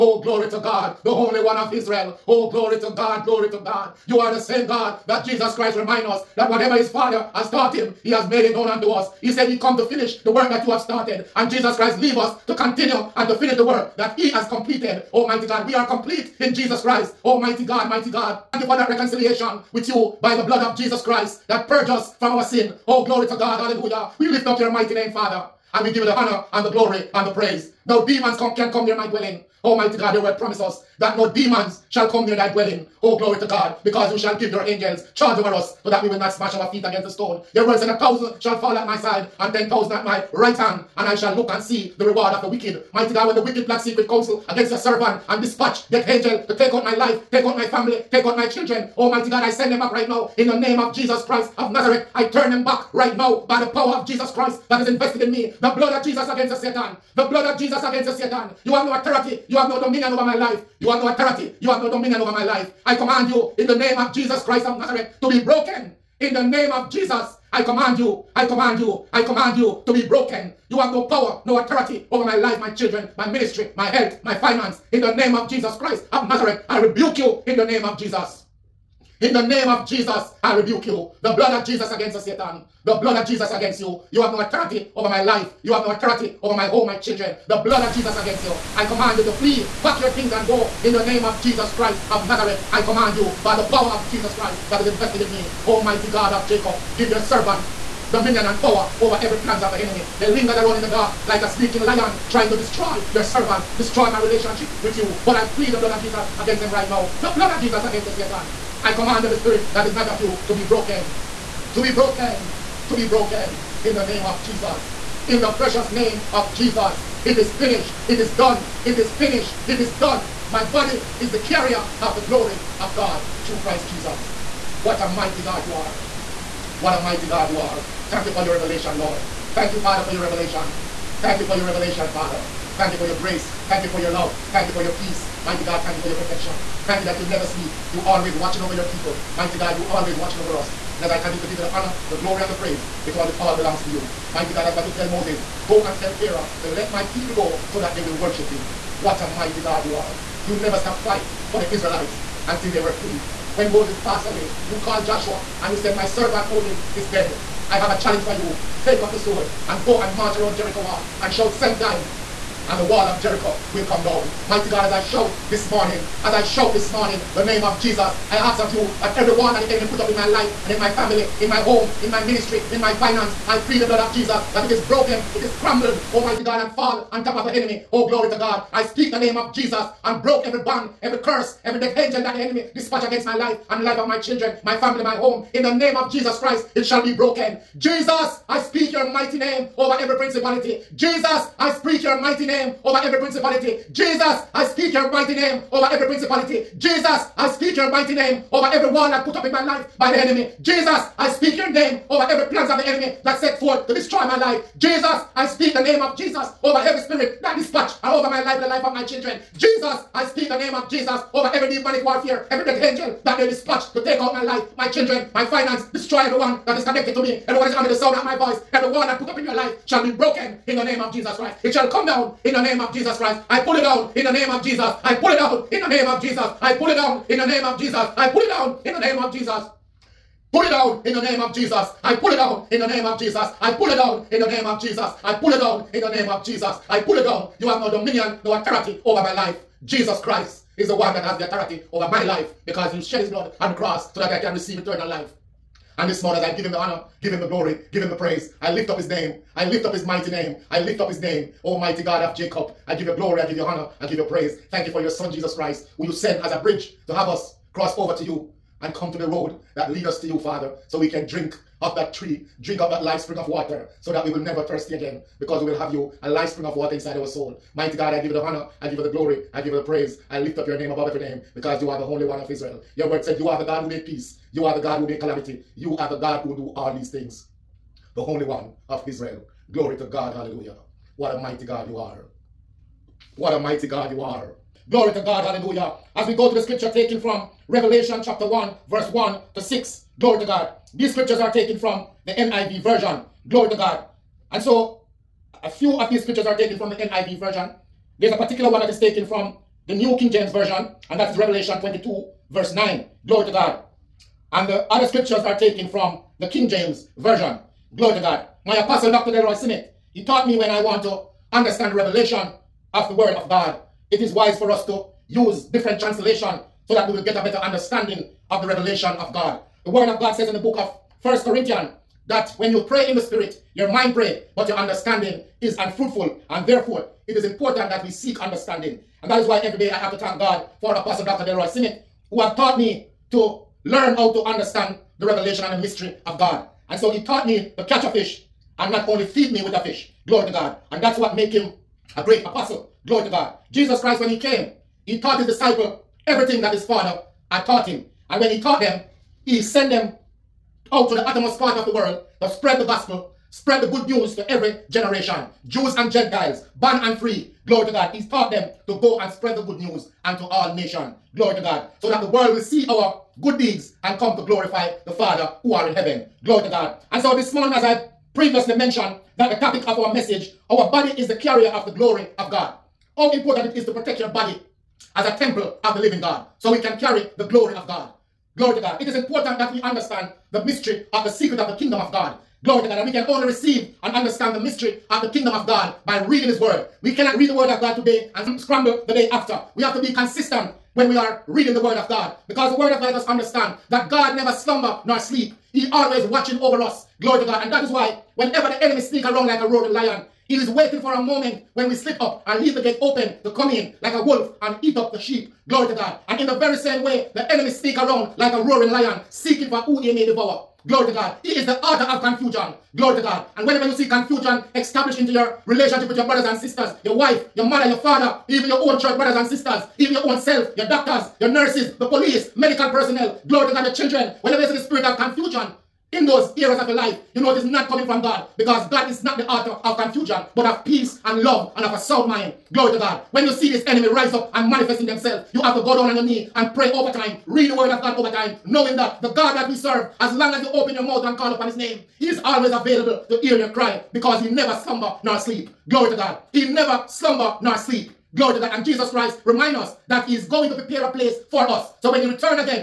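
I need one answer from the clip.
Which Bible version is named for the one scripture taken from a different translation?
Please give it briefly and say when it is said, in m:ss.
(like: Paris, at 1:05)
New King James Version, at 4:59.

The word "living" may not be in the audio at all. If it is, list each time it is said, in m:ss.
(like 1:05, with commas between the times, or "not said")
6:15.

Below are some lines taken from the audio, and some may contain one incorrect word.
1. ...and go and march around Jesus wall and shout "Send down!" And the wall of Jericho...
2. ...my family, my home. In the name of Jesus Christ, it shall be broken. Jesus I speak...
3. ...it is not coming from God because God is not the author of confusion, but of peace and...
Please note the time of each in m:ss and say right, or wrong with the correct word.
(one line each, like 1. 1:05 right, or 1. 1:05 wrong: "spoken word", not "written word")
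1. 2:39 wrong: "Jericho", not "Jesus"
2. 3:04 right
3. 7:07 right.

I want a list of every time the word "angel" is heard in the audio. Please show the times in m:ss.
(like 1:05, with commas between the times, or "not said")
0:34, 0:46, 3:01, 3:32.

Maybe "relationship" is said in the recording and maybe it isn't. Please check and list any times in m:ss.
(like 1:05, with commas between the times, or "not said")
1:44, 6:55.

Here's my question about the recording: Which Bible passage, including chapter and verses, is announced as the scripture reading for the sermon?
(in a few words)
Revelation 1:1-6.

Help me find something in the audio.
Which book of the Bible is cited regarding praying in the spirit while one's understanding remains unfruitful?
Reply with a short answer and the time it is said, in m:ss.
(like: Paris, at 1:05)
First Corinthians, at 5:21.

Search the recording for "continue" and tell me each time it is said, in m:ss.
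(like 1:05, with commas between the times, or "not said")
0:12, 2:21.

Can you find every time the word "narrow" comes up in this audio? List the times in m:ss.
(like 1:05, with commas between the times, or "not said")
not said.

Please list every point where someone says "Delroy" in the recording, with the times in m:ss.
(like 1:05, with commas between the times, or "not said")
5:09, 5:31.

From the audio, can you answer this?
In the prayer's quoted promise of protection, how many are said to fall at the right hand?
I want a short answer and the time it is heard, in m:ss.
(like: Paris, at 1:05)
10,000, at 0:39.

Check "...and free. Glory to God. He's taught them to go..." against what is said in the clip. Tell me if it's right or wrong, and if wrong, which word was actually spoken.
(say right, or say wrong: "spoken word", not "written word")
right.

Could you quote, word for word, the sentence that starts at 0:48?
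Almighty God, I send them back right now in the name of Jesus Christ of Nazareth.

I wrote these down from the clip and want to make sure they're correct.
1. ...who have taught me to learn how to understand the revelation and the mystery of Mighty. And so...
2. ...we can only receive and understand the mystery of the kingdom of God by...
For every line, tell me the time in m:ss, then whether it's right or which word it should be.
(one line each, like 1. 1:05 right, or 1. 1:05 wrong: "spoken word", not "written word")
1. 5:32 wrong: "God", not "Mighty"
2. 6:23 right.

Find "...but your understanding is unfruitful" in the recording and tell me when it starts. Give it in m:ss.
5:24.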